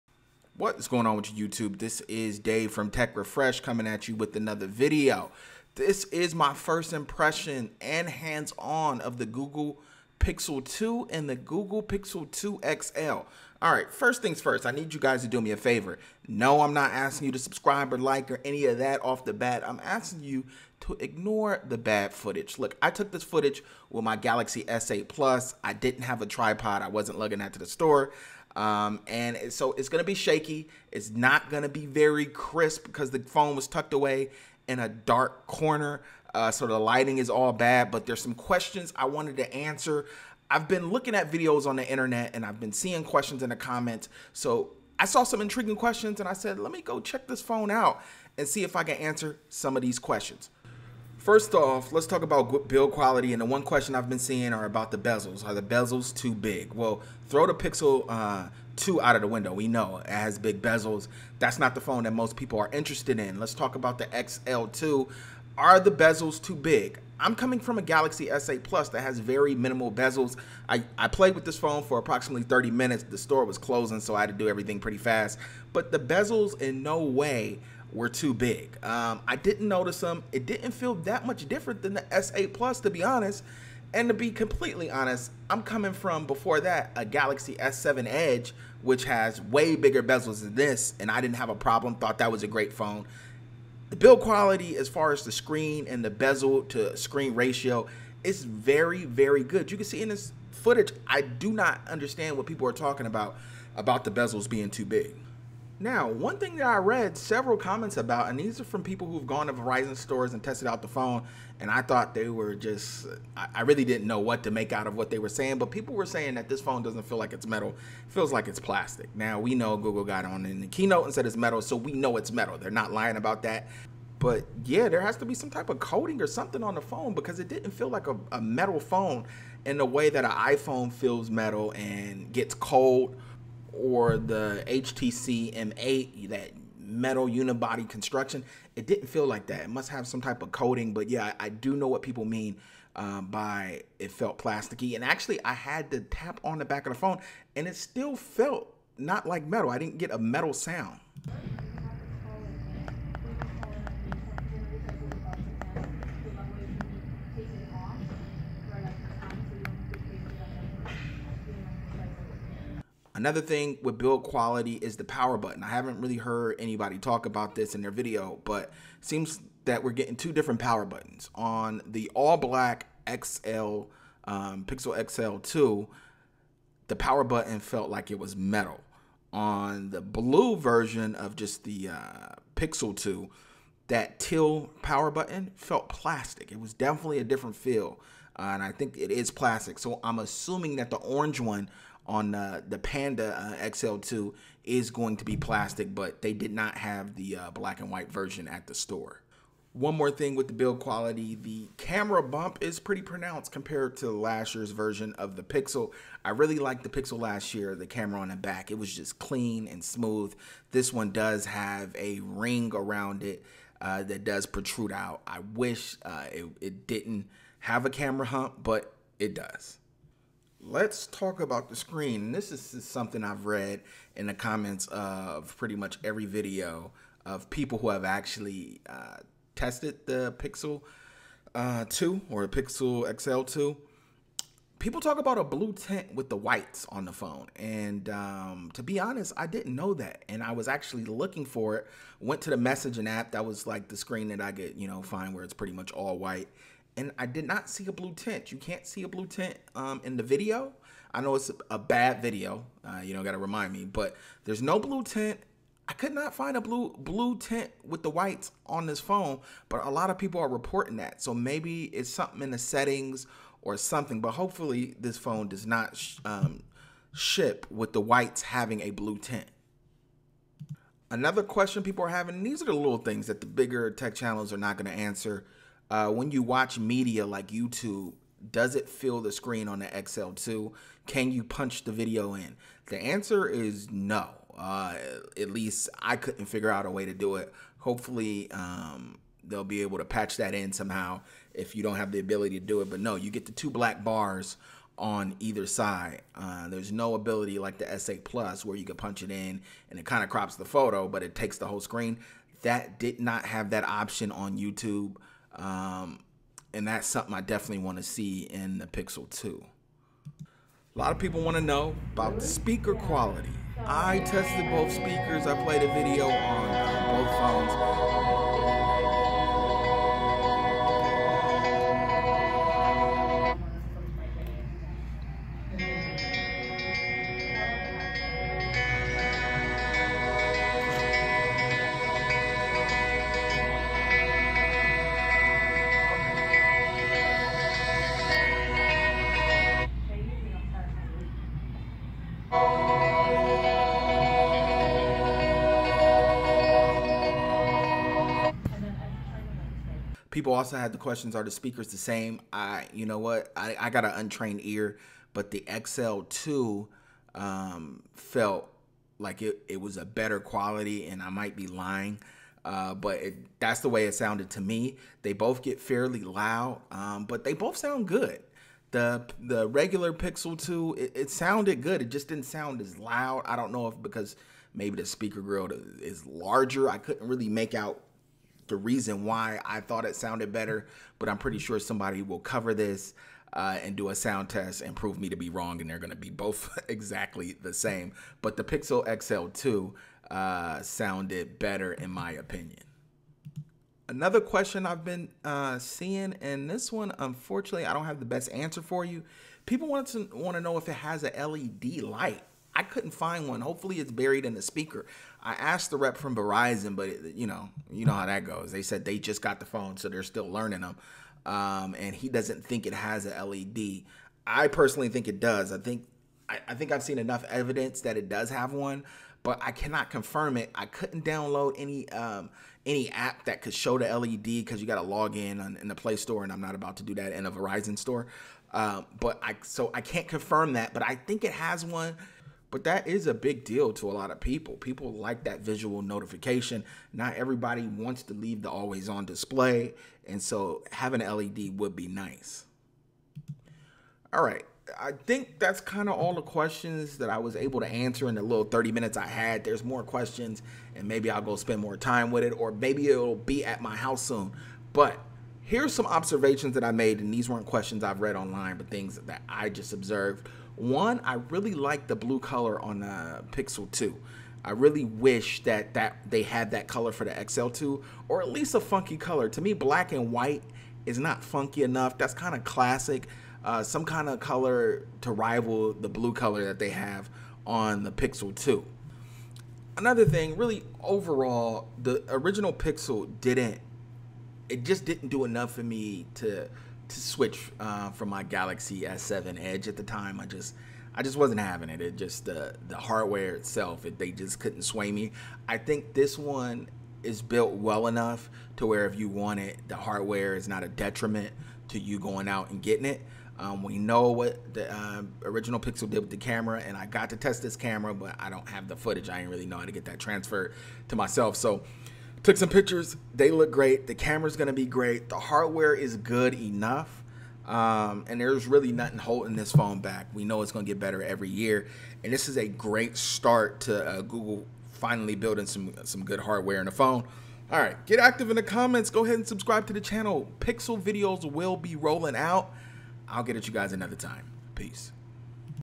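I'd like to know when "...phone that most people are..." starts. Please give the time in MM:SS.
01:01.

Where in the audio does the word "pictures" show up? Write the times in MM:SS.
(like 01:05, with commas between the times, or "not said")
08:32.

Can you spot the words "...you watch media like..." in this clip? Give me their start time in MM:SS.
04:36.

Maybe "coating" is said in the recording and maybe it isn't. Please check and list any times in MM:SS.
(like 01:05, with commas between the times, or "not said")
02:05, 02:20.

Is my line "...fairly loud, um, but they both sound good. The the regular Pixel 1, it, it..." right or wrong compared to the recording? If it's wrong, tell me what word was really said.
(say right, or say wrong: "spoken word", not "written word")
wrong: "2", not "1".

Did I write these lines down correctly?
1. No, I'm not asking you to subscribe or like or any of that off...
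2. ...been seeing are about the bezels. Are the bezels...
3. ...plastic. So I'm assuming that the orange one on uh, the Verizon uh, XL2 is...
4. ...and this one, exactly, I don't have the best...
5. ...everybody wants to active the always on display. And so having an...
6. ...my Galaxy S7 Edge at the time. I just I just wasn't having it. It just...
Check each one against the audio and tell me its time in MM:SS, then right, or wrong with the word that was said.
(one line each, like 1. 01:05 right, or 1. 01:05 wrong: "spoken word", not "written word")
1. 00:16 right
2. 00:54 right
3. 03:09 wrong: "Panda", not "Verizon"
4. 06:36 wrong: "unfortunately", not "exactly"
5. 07:17 wrong: "leave", not "active"
6. 08:08 right.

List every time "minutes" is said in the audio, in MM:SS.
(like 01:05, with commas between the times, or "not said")
01:12, 07:28.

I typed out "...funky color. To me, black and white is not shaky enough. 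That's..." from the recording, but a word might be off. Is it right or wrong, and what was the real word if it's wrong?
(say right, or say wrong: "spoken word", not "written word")
wrong: "funky", not "shaky".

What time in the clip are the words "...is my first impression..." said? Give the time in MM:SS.
00:06.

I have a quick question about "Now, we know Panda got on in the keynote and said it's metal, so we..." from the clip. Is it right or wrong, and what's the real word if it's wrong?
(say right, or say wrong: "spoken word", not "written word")
wrong: "Google", not "Panda".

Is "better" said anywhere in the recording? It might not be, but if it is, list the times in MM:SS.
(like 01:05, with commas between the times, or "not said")
06:00, 06:20, 06:31, 08:40.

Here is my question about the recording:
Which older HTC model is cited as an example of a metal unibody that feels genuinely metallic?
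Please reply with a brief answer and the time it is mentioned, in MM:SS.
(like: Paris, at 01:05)
HTC M8, at 02:14.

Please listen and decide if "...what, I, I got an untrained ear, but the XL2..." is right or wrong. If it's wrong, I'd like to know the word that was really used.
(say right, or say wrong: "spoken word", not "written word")
right.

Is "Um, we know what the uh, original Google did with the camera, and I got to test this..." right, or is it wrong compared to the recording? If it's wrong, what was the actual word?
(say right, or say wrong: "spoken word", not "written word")
wrong: "Pixel", not "Google".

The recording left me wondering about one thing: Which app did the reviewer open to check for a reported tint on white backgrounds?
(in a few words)
Messaging app.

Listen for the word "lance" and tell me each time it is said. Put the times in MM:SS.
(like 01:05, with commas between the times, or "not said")
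not said.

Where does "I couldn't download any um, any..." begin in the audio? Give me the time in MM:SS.
07:00.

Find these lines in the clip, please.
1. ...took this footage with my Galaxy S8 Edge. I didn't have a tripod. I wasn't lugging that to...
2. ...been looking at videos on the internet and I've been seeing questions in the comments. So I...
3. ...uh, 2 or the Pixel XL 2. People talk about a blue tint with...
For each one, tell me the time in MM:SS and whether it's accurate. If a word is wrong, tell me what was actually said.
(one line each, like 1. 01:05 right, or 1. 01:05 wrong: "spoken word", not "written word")
1. 00:22 wrong: "Plus", not "Edge"
2. 00:40 right
3. 03:51 right.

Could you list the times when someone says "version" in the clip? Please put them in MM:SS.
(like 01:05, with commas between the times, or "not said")
03:00, 03:18, 03:24.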